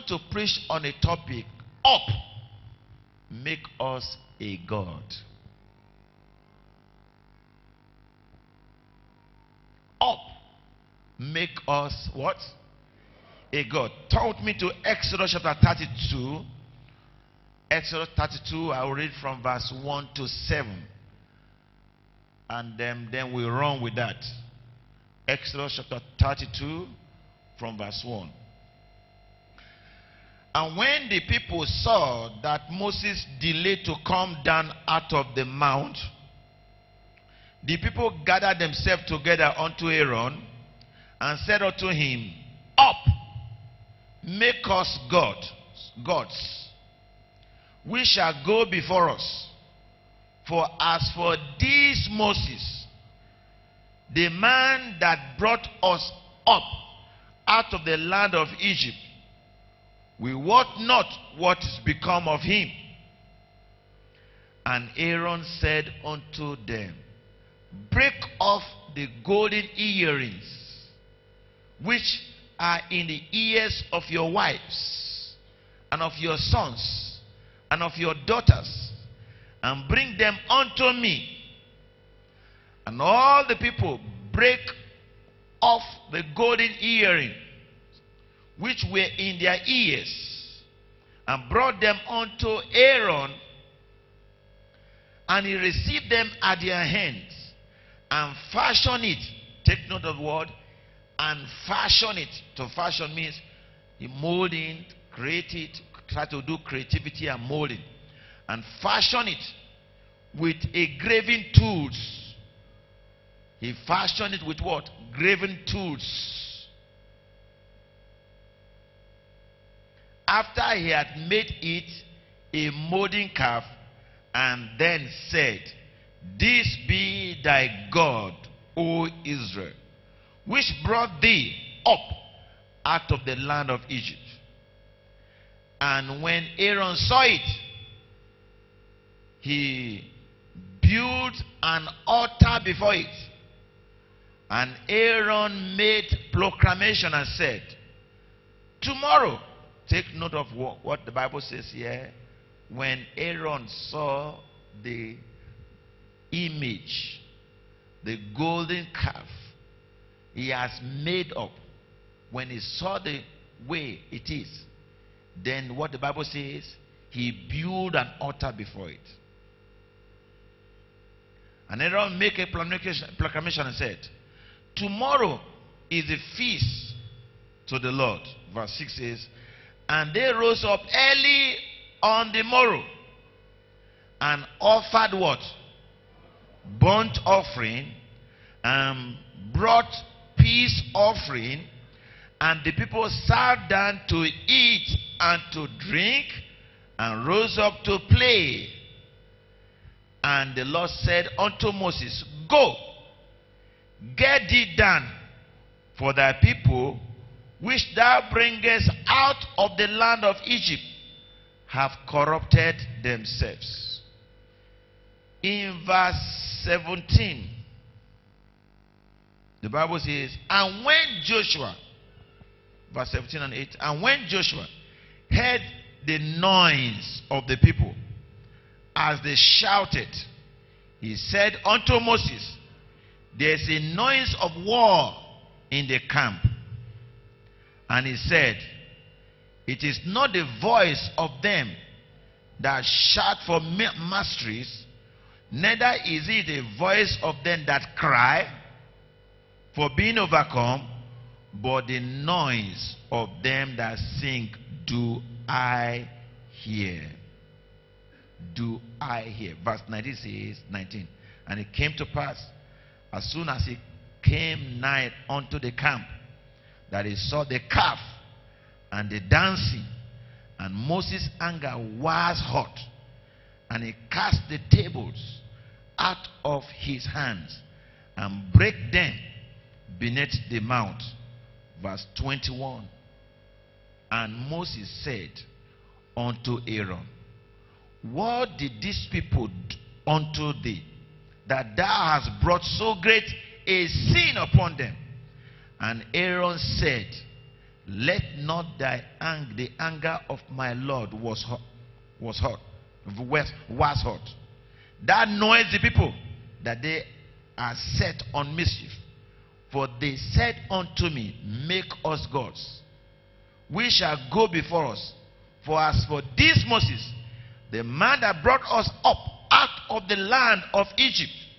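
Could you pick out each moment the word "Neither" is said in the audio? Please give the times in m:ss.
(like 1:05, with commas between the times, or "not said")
4:05.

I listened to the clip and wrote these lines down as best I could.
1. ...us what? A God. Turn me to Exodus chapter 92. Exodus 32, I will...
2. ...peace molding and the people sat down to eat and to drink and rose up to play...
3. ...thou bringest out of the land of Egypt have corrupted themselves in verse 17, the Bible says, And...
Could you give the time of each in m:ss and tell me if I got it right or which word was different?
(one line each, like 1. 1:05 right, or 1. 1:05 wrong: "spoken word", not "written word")
1. 0:11 wrong: "32", not "92"
2. 3:10 wrong: "offering", not "molding"
3. 3:27 right.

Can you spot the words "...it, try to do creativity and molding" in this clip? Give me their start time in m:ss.
1:45.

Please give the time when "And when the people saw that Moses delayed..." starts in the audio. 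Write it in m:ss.
0:30.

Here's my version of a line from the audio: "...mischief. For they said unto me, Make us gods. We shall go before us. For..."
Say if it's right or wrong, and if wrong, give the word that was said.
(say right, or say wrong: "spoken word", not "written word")
right.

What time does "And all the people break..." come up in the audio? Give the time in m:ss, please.
1:22.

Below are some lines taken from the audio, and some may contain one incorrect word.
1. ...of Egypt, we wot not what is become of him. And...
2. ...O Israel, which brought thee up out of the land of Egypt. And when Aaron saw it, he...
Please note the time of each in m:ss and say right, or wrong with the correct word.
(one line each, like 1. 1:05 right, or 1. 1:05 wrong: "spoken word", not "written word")
1. 0:58 right
2. 2:08 right.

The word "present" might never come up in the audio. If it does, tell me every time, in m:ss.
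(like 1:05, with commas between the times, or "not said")
not said.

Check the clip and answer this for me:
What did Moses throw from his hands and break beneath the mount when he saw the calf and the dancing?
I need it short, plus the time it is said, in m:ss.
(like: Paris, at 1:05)
The tables, at 4:34.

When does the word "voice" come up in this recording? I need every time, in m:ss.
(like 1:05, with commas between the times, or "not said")
4:00, 4:06.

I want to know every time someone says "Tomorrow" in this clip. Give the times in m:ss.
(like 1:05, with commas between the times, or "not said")
2:28, 2:54.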